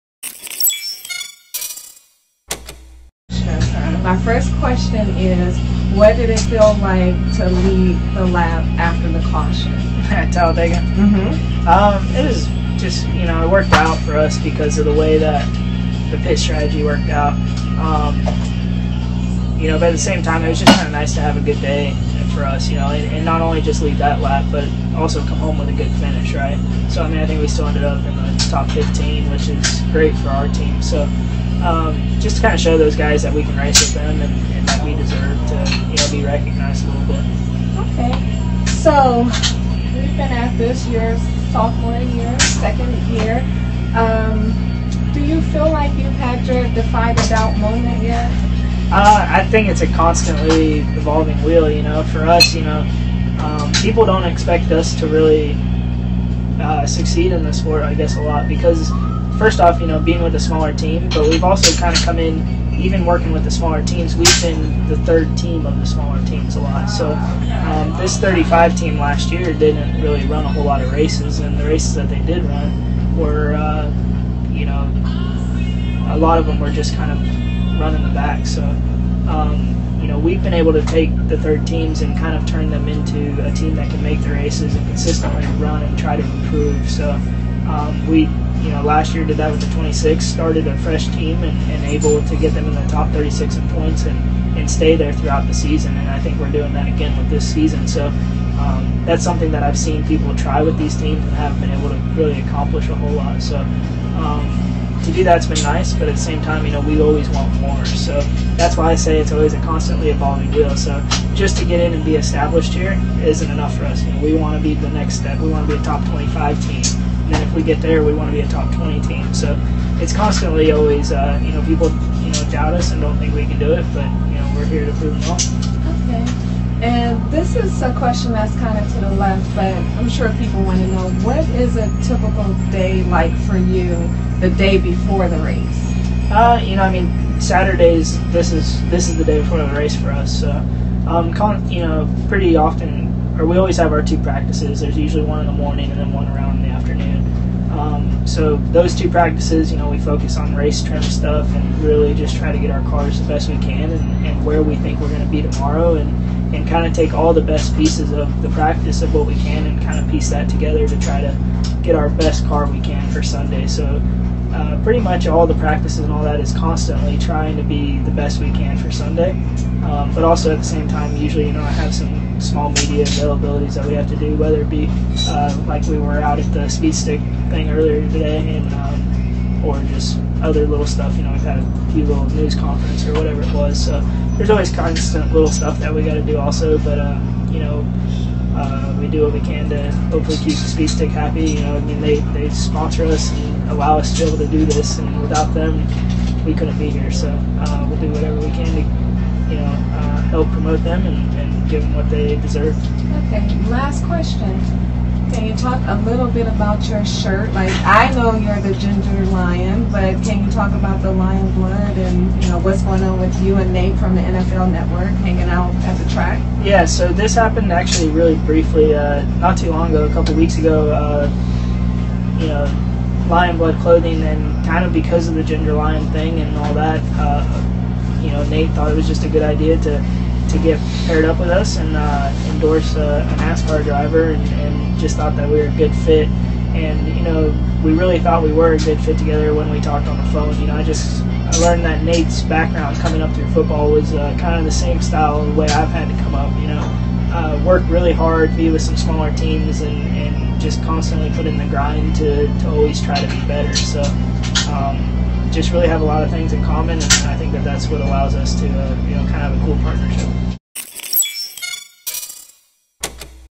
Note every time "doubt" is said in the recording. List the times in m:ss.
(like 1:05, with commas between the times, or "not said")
0:47, 2:02.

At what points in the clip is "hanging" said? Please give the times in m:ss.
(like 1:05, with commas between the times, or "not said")
3:35.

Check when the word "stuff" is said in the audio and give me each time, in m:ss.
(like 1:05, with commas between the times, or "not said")
2:31, 3:00, 3:05.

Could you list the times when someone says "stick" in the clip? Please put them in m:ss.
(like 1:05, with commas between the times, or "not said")
2:56, 3:10.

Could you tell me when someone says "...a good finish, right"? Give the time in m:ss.
0:25.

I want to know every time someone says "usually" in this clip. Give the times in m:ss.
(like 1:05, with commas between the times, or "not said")
2:24, 2:51.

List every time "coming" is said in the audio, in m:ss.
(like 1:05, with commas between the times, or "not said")
4:02.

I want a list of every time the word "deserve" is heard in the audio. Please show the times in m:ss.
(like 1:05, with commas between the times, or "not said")
0:34, 3:22.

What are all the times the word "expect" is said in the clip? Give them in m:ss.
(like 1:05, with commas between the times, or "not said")
0:54.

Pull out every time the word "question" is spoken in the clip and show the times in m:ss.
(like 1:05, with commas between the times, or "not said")
0:04, 2:07, 3:24.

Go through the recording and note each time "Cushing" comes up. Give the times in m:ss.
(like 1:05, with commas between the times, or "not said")
not said.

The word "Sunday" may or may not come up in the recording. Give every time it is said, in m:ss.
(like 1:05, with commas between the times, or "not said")
2:43, 2:48.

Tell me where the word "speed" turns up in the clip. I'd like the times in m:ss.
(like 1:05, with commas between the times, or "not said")
2:56, 3:10.